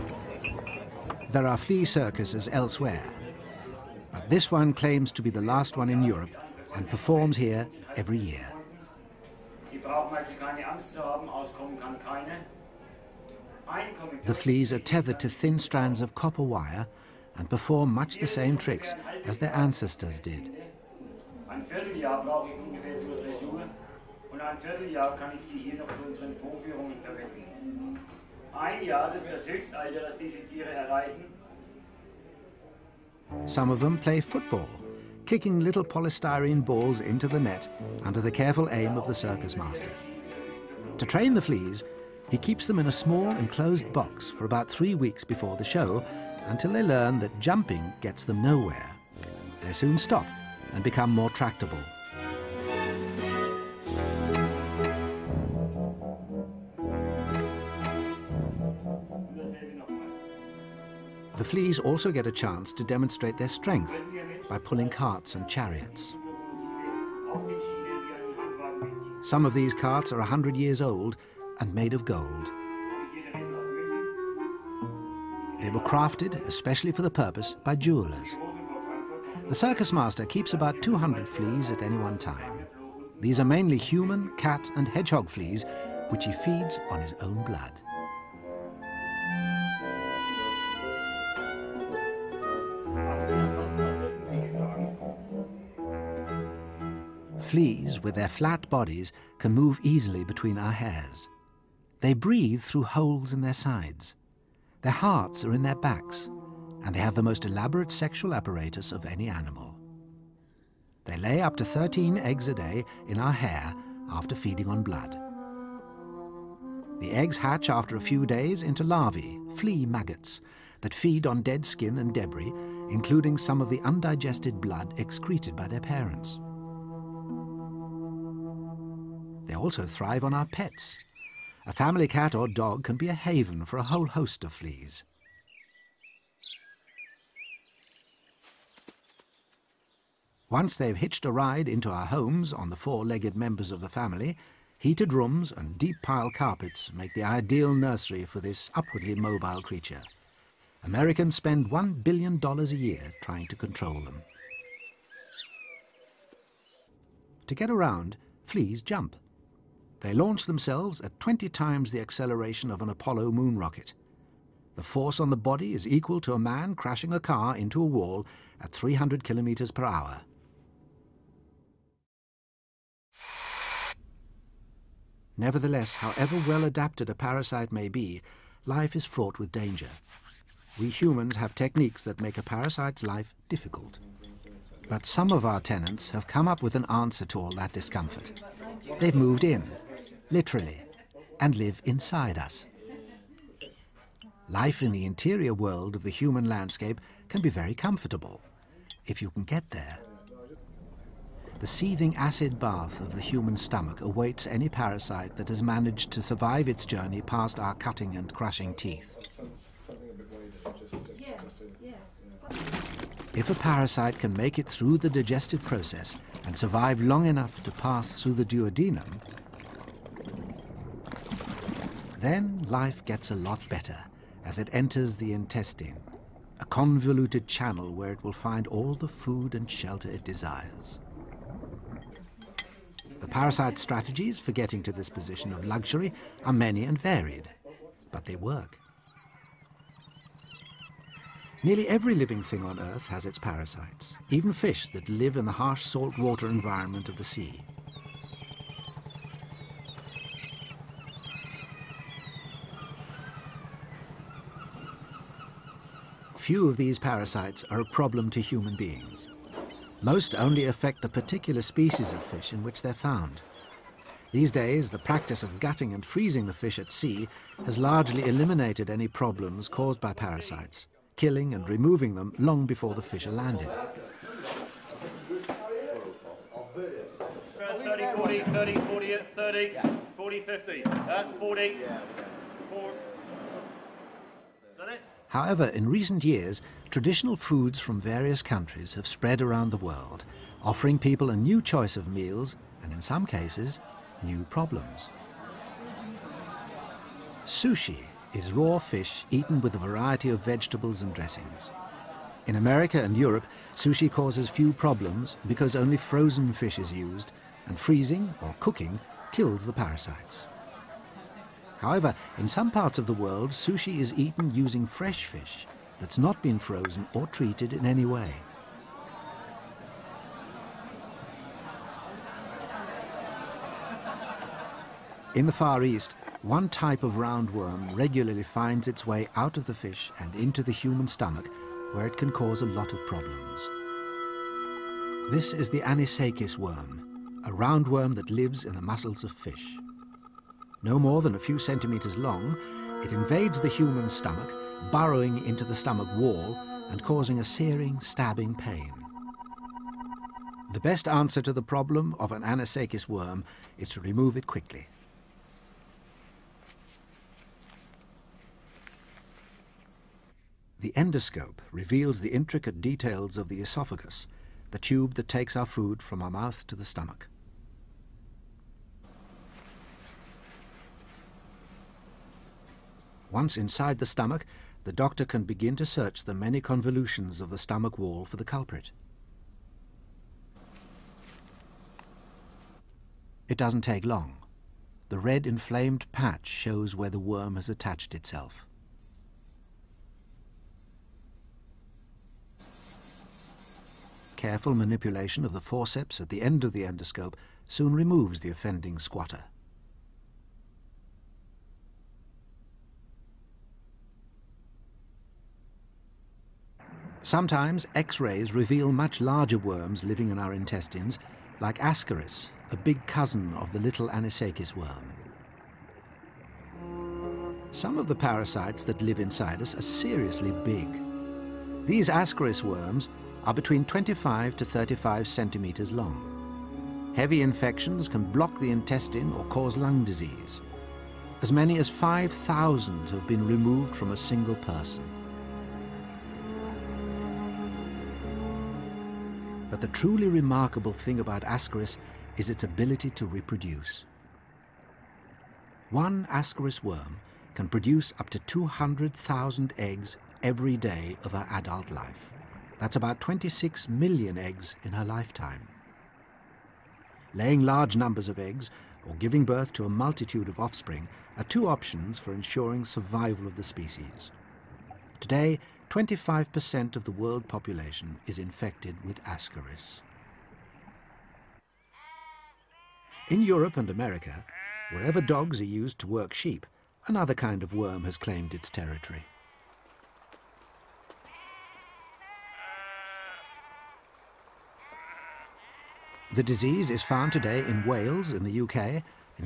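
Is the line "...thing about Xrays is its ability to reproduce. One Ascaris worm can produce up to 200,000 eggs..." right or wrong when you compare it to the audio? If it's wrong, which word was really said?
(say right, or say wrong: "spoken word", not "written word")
wrong: "Ascaris", not "Xrays".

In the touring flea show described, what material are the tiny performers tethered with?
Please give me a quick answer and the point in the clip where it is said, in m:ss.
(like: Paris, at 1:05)
copper wire, at 0:16.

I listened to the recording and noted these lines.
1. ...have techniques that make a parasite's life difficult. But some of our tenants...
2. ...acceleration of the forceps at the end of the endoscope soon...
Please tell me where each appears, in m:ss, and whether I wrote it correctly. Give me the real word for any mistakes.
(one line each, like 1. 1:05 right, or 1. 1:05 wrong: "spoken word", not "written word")
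1. 3:01 right
2. 6:34 wrong: "manipulation", not "acceleration".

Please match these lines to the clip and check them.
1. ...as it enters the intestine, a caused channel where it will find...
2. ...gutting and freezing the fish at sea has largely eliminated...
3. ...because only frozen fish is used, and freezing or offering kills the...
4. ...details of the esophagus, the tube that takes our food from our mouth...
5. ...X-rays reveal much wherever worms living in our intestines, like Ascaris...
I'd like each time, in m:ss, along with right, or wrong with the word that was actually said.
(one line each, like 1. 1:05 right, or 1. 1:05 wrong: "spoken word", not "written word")
1. 3:44 wrong: "convoluted", not "caused"
2. 4:25 right
3. 5:05 wrong: "cooking", not "offering"
4. 6:02 right
5. 6:47 wrong: "larger", not "wherever".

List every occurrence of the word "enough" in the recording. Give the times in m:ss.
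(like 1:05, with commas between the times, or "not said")
3:37.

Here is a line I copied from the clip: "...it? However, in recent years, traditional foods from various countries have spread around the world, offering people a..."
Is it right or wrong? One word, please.
right.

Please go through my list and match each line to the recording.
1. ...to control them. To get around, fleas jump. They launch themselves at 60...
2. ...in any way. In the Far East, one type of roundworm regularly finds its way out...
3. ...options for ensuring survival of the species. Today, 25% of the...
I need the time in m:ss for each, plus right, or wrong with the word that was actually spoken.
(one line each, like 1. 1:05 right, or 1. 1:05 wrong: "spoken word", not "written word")
1. 2:33 wrong: "20", not "60"
2. 5:17 right
3. 7:41 right.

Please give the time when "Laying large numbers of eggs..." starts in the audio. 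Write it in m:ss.
7:37.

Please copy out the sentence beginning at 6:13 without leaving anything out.
Once inside the stomach, the doctor can begin to search the many convolutions of the stomach wall for the culprit.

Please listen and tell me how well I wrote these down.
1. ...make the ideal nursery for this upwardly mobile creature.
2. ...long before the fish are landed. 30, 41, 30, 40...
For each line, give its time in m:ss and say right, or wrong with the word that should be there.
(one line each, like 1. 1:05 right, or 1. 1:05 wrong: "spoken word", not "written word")
1. 2:26 right
2. 4:32 wrong: "40", not "41".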